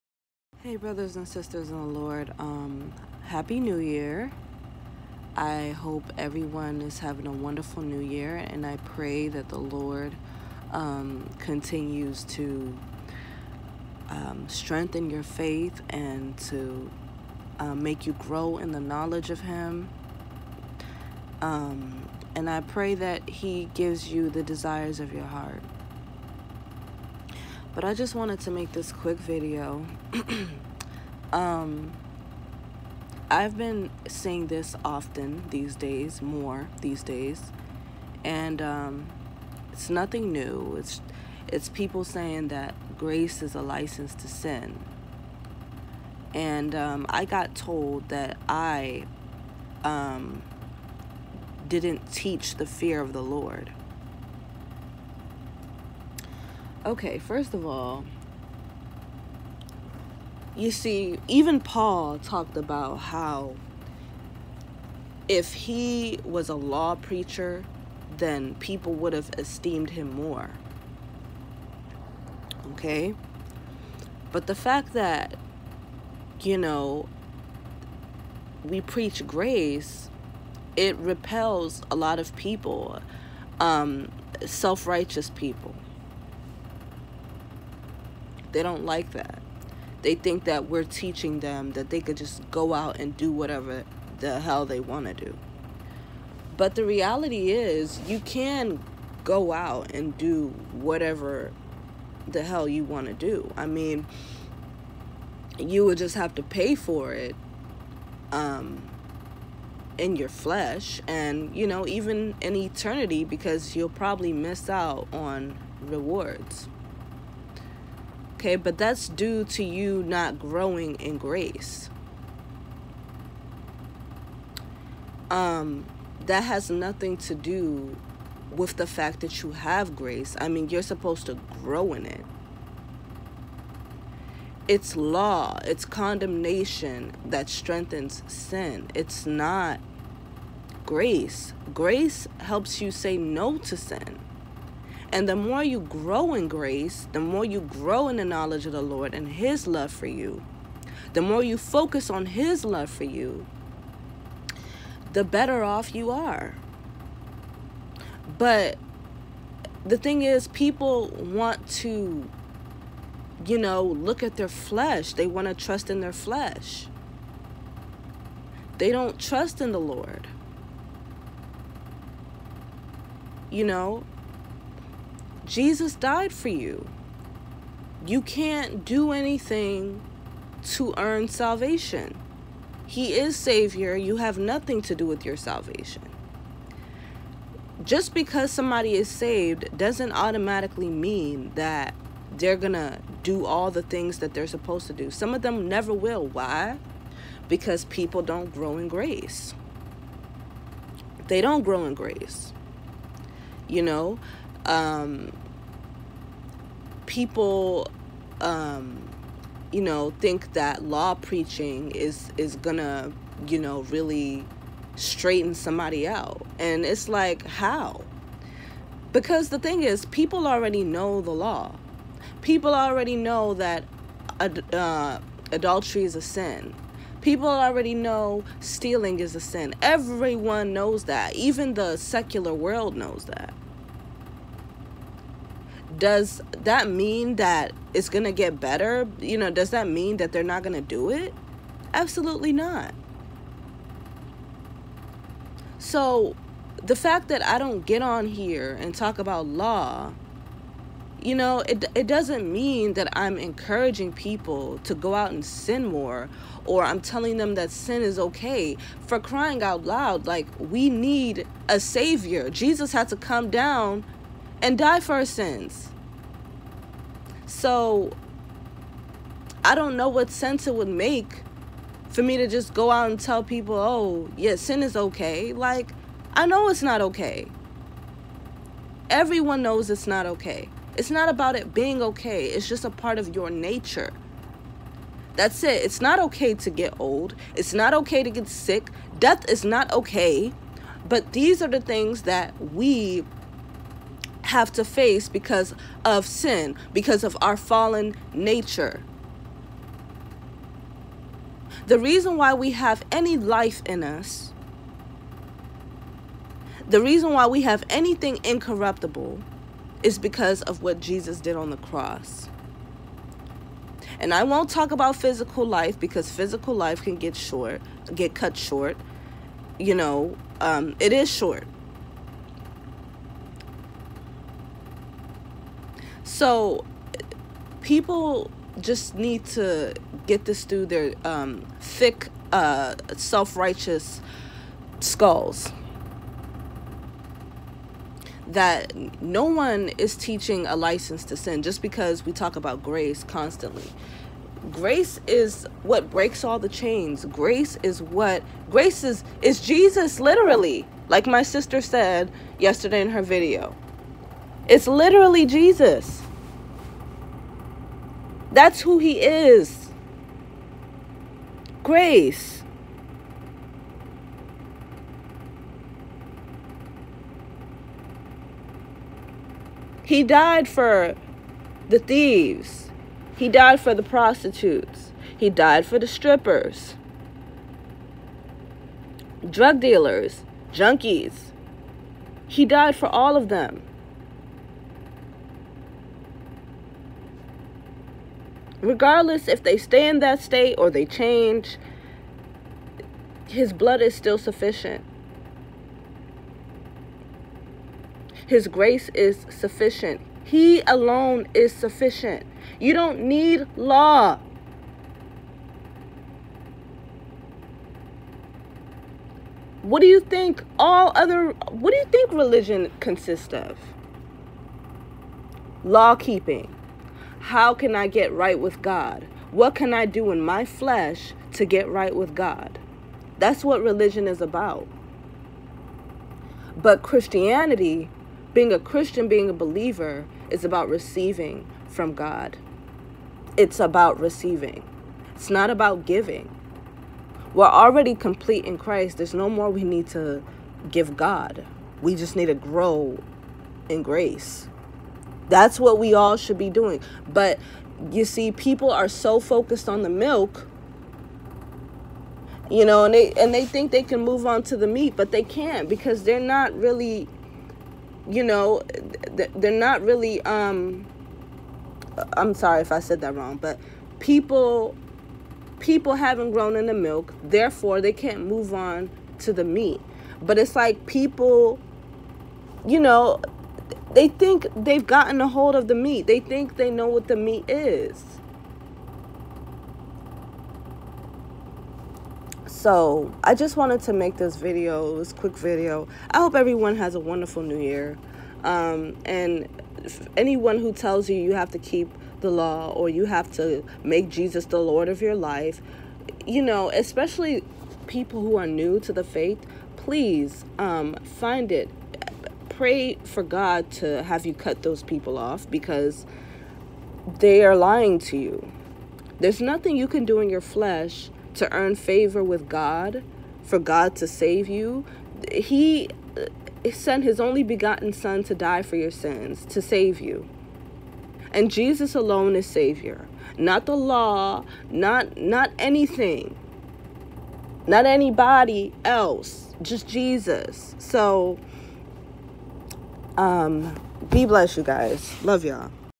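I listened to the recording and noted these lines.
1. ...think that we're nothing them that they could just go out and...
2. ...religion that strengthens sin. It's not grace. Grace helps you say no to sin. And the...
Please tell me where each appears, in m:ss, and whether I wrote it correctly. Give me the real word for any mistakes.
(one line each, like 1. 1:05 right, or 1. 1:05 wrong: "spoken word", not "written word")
1. 1:30 wrong: "teaching", not "nothing"
2. 2:15 wrong: "condemnation", not "religion".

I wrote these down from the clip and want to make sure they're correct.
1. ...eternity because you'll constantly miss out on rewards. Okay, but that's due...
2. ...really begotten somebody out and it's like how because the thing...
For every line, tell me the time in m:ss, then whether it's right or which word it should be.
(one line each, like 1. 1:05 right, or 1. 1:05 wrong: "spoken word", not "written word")
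1. 1:52 wrong: "probably", not "constantly"
2. 3:33 wrong: "straighten", not "begotten".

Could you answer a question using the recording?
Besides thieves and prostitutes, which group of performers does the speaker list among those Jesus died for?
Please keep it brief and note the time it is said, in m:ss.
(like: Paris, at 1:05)
strippers, at 6:16.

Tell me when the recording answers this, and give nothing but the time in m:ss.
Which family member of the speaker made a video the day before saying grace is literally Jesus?
5:51.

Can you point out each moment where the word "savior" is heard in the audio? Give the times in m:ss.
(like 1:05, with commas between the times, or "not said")
3:03, 4:21, 8:42.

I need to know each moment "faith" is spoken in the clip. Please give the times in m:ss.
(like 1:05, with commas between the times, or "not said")
0:15, 8:19.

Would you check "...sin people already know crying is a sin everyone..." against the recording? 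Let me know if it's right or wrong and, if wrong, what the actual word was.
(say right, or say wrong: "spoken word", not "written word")
wrong: "stealing", not "crying".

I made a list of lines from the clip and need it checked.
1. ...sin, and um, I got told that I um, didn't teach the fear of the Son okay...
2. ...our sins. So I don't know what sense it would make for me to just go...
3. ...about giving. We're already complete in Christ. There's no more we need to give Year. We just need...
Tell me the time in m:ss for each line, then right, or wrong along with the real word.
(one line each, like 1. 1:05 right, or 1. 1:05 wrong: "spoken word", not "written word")
1. 0:44 wrong: "Lord", not "Son"
2. 4:25 right
3. 7:15 wrong: "God", not "Year".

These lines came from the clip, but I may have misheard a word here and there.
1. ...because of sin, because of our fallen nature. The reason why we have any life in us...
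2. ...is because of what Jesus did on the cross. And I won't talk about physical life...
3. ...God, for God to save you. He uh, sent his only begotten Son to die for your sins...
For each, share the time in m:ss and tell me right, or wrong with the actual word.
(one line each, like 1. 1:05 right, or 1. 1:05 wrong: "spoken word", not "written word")
1. 4:55 right
2. 5:10 right
3. 8:32 right.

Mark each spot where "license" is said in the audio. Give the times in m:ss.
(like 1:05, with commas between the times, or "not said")
0:43, 5:40.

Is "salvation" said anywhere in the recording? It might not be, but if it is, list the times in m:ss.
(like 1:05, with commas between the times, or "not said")
3:01, 3:05.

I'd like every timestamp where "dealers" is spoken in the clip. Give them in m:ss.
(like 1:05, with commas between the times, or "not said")
6:19.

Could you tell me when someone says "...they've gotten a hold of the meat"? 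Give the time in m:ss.
7:54.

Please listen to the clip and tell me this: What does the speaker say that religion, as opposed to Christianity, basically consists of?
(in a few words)
law keeping.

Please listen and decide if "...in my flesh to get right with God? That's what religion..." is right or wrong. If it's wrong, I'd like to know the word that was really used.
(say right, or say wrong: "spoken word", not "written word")
right.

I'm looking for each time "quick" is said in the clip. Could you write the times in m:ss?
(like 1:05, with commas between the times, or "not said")
0:28, 8:05.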